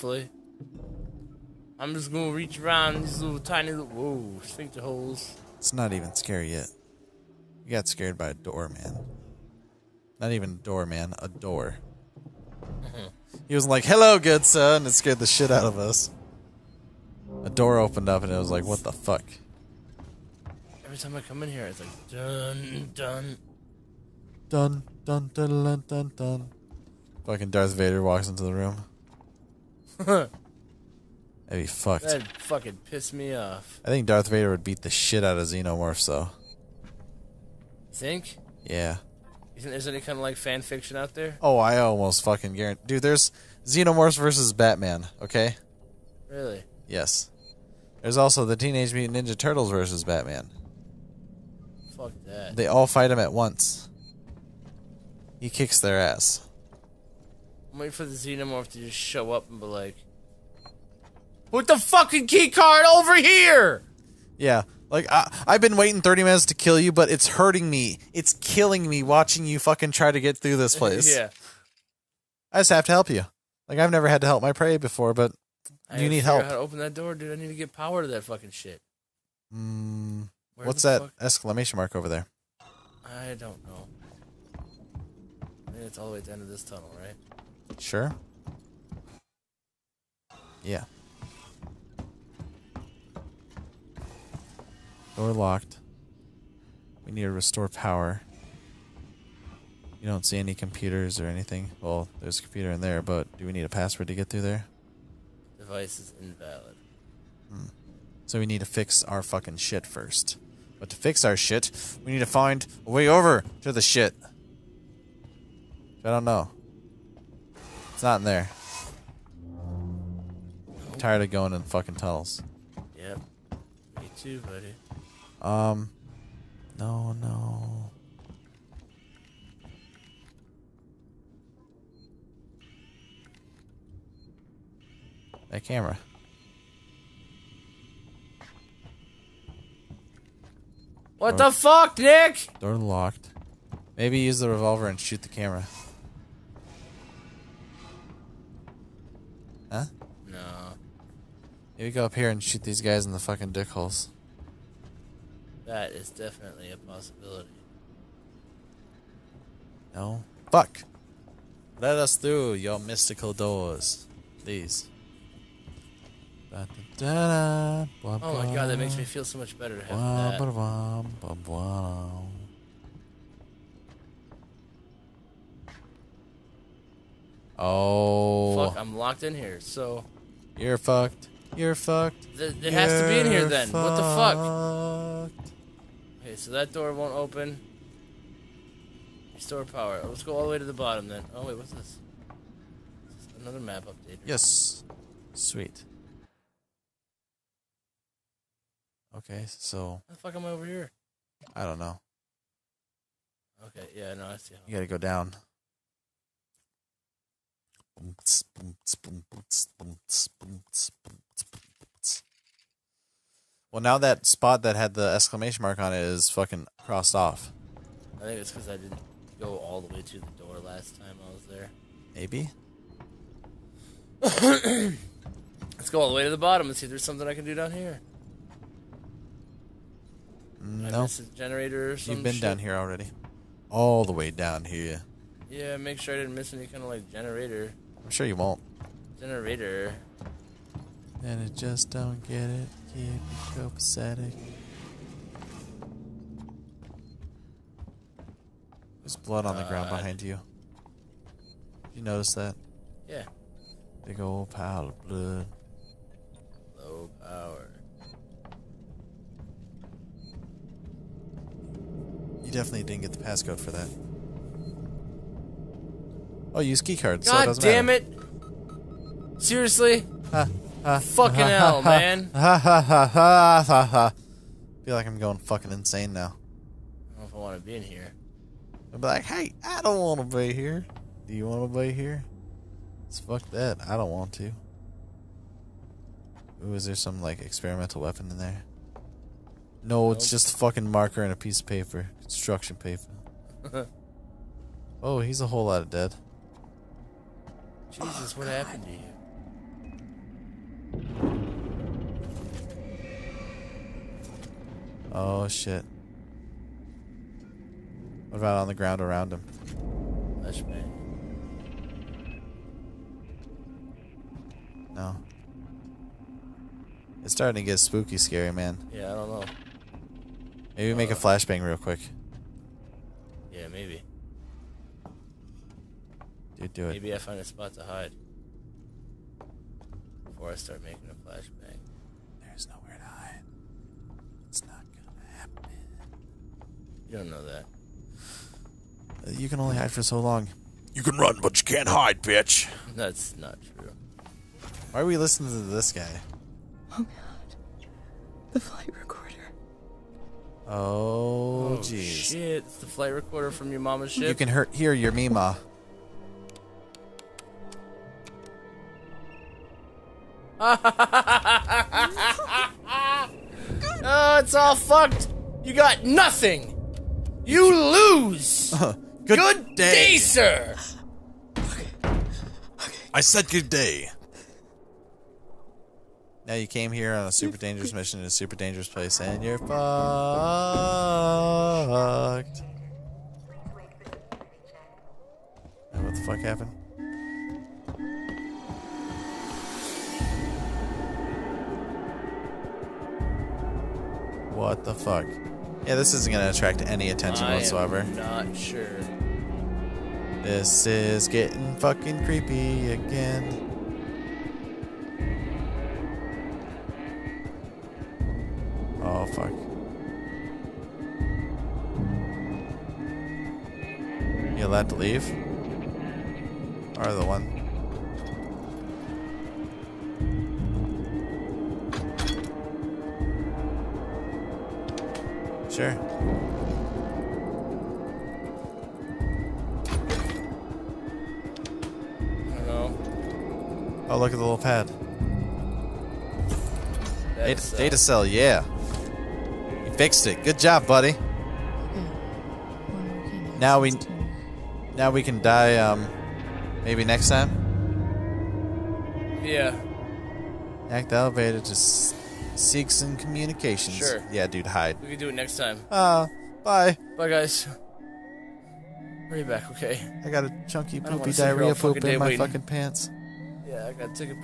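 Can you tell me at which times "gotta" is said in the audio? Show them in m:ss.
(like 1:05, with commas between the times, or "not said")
3:24, 7:43.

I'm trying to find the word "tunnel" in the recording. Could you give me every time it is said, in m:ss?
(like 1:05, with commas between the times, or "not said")
1:26, 2:01.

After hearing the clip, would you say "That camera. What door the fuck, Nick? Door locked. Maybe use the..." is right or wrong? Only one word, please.
right.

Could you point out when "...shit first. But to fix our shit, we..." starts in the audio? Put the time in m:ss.
1:49.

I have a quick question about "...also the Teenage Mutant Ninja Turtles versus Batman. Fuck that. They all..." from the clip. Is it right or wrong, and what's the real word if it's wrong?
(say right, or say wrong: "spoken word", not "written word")
right.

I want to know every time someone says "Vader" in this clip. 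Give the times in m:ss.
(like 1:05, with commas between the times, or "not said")
0:27, 0:34.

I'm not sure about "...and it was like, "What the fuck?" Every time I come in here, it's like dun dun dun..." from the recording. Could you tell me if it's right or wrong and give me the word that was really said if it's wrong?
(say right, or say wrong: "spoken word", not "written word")
right.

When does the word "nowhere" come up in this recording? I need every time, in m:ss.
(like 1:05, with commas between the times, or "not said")
5:32.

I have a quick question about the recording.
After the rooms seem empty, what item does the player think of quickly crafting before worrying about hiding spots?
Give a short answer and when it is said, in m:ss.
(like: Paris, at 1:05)
flashbang, at 5:21.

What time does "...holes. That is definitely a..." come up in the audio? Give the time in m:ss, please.
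2:33.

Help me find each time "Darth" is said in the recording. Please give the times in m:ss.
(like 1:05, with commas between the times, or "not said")
0:27, 0:34.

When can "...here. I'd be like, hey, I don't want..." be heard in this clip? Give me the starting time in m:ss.
4:37.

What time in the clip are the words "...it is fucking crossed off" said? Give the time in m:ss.
3:35.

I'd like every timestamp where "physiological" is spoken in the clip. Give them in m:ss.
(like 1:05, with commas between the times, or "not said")
not said.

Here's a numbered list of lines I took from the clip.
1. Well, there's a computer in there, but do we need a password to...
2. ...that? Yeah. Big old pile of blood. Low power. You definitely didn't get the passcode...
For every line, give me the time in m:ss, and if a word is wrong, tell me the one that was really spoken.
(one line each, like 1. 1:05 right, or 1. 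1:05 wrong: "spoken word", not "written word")
1. 1:41 right
2. 4:12 right.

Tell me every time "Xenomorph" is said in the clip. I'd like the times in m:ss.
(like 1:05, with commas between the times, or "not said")
0:35, 0:43, 0:58.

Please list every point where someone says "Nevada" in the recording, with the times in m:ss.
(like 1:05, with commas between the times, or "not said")
not said.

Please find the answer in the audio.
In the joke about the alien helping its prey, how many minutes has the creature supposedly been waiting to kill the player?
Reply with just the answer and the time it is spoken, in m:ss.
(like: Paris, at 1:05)
30, at 1:06.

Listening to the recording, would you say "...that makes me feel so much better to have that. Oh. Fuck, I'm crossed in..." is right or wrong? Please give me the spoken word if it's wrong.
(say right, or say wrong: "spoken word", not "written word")
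wrong: "locked", not "crossed".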